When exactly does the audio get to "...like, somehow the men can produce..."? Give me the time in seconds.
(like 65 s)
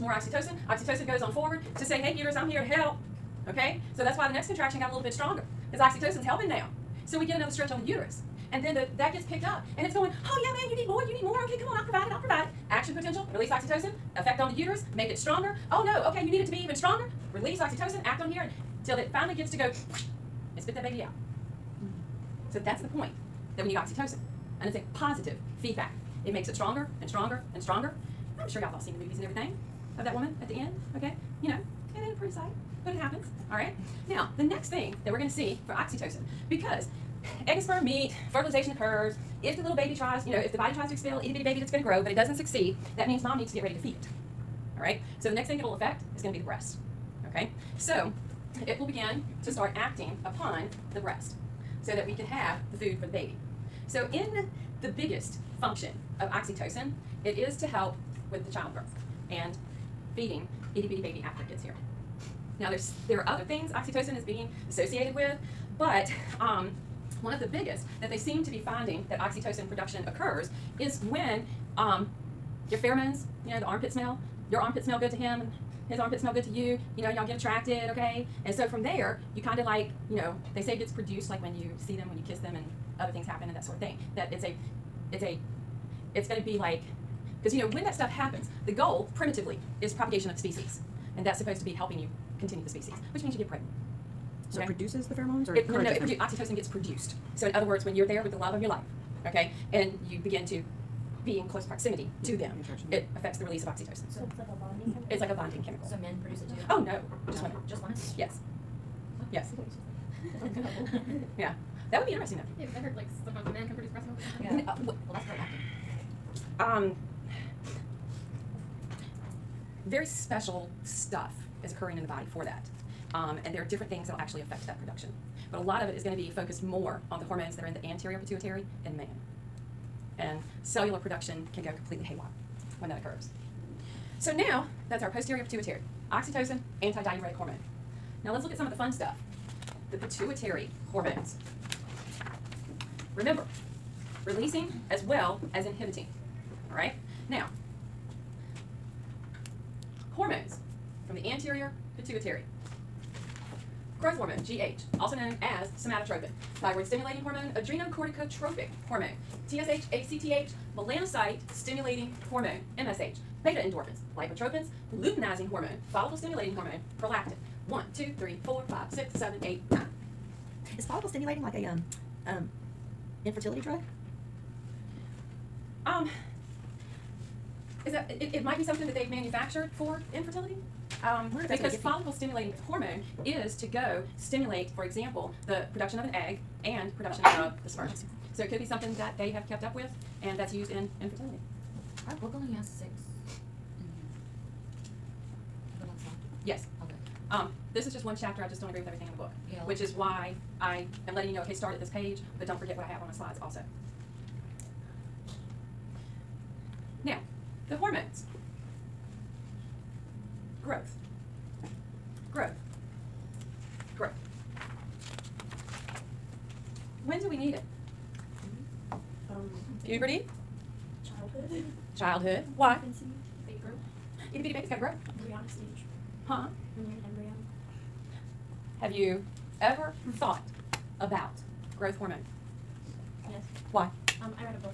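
112 s.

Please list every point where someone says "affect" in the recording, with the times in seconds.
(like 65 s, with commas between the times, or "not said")
45 s, 103 s, 124 s.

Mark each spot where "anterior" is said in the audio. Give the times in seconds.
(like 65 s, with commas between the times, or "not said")
127 s, 151 s.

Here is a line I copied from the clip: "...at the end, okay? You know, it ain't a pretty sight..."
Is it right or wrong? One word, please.
right.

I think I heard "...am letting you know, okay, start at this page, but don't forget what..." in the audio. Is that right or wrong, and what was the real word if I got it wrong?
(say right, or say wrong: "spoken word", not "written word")
right.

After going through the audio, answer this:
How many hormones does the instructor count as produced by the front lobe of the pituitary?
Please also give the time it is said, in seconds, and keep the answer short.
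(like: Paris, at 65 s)
9, at 169 s.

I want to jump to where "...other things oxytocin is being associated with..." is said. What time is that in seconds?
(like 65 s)
63 s.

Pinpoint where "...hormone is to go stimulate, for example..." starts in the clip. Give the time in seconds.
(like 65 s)
182 s.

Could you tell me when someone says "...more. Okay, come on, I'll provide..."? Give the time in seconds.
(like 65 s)
11 s.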